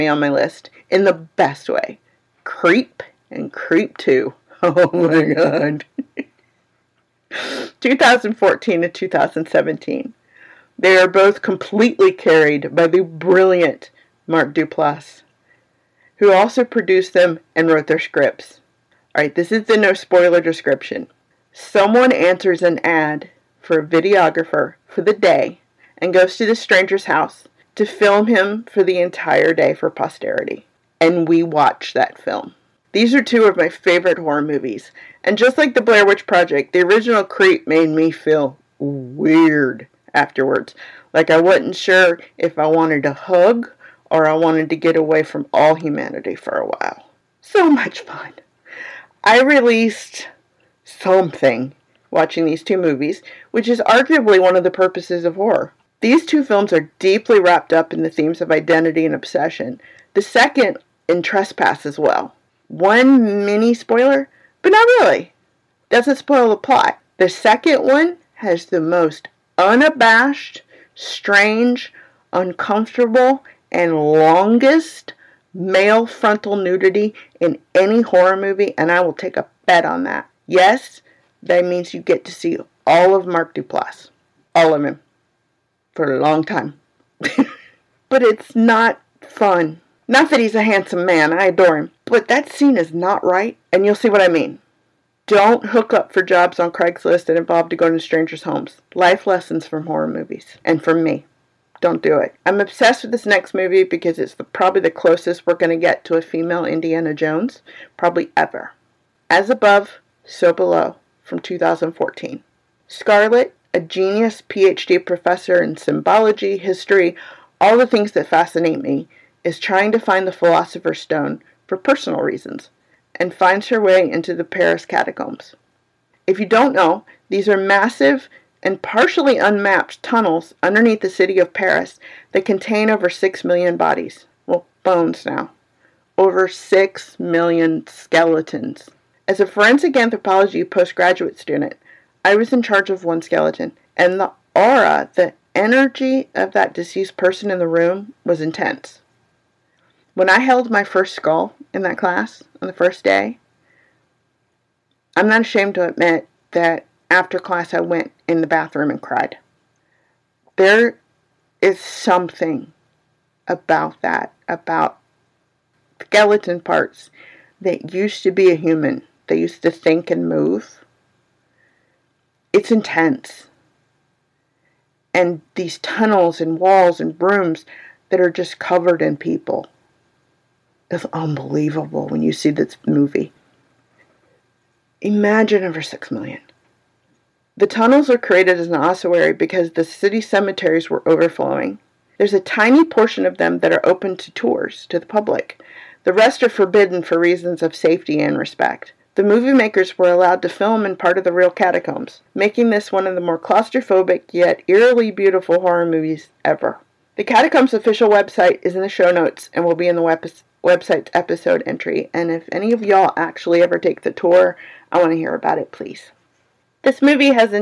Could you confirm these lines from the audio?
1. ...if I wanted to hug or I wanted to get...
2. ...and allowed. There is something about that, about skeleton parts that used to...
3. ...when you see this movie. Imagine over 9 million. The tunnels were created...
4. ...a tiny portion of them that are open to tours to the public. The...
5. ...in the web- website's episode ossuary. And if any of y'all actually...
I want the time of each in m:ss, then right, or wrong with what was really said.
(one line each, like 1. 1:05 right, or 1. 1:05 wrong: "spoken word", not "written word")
1. 0:42 right
2. 2:38 wrong: "cried", not "allowed"
3. 3:02 wrong: "6", not "9"
4. 3:12 right
5. 3:29 wrong: "entry", not "ossuary".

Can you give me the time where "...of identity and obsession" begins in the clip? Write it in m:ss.
0:58.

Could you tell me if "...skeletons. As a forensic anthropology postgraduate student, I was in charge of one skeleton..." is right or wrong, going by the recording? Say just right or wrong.
right.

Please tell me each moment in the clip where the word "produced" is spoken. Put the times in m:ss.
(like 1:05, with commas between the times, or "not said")
0:16.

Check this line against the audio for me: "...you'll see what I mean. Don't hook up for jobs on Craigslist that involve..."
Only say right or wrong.
right.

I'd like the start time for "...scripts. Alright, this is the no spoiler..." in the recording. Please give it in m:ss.
0:18.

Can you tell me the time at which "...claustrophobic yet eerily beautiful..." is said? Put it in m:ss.
3:23.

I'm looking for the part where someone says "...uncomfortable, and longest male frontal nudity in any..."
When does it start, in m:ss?
1:12.